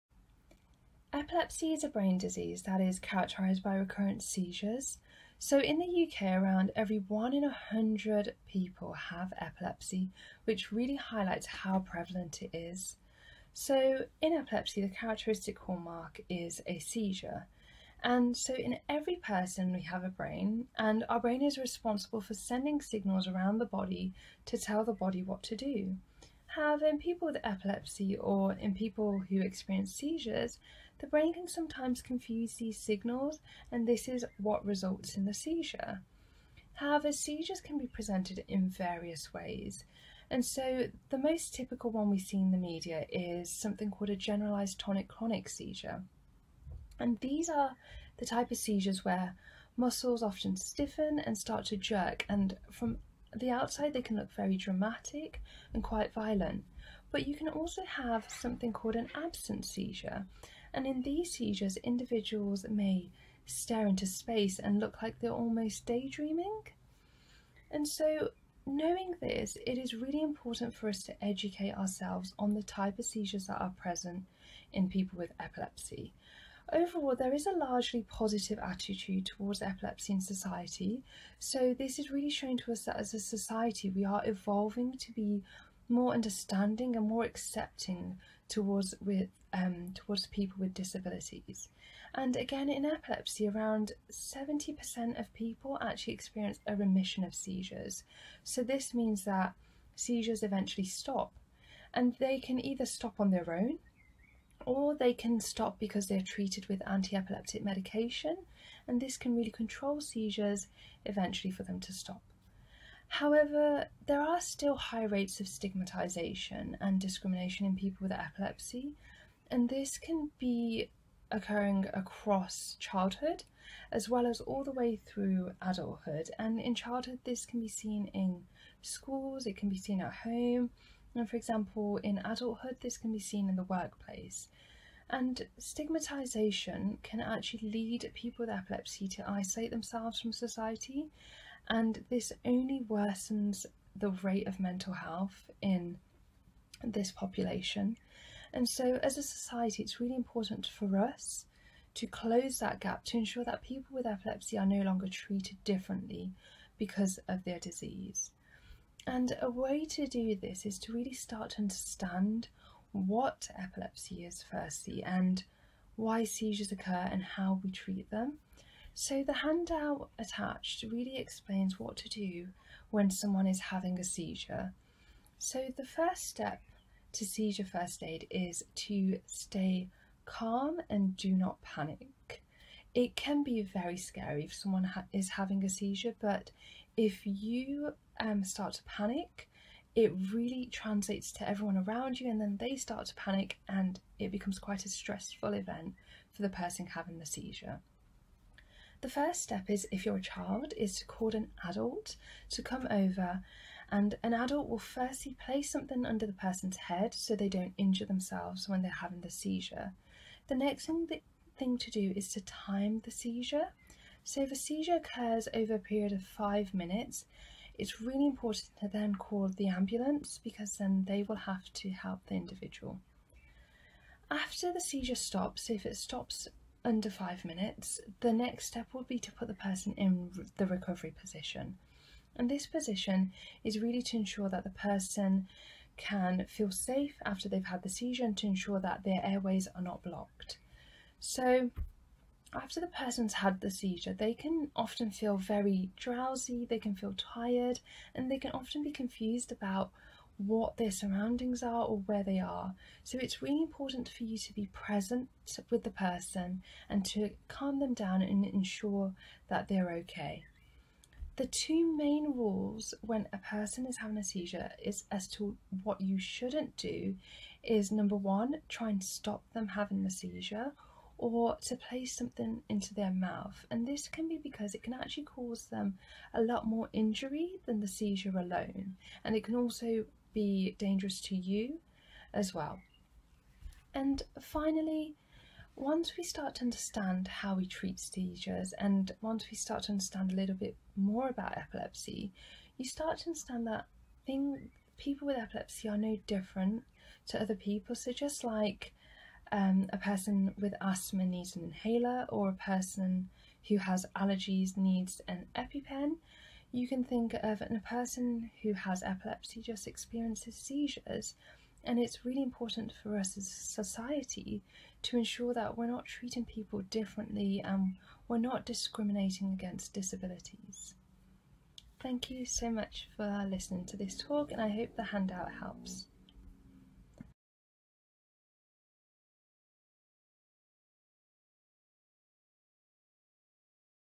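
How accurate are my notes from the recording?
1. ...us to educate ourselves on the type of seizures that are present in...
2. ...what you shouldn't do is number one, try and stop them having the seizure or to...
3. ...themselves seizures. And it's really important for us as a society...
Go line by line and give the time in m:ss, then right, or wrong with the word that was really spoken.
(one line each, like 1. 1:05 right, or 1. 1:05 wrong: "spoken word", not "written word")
1. 1:10 right
2. 4:25 right
3. 5:09 wrong: "experiences", not "themselves".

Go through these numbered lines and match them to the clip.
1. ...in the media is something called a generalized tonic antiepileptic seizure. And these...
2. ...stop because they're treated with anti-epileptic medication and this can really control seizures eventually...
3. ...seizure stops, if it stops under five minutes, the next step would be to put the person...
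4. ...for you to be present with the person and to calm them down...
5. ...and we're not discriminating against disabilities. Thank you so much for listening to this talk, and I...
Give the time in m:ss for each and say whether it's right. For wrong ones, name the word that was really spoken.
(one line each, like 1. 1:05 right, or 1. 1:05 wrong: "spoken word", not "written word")
1. 0:42 wrong: "clonic", not "antiepileptic"
2. 1:45 right
3. 3:44 right
4. 4:14 right
5. 5:17 right.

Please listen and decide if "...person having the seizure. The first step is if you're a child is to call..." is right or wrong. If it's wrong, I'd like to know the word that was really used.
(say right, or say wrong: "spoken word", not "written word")
right.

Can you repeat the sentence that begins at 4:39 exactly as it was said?
And it can also be dangerous to you as well.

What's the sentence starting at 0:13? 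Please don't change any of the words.
So, in epilepsy, the characteristic hallmark is a seizure.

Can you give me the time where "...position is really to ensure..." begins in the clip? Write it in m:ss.
3:52.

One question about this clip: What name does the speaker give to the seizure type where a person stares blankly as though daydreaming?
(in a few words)
absent seizure.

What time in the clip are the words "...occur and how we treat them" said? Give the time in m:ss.
2:46.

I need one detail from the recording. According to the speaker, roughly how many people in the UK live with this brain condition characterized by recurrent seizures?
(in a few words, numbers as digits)
1 in 100.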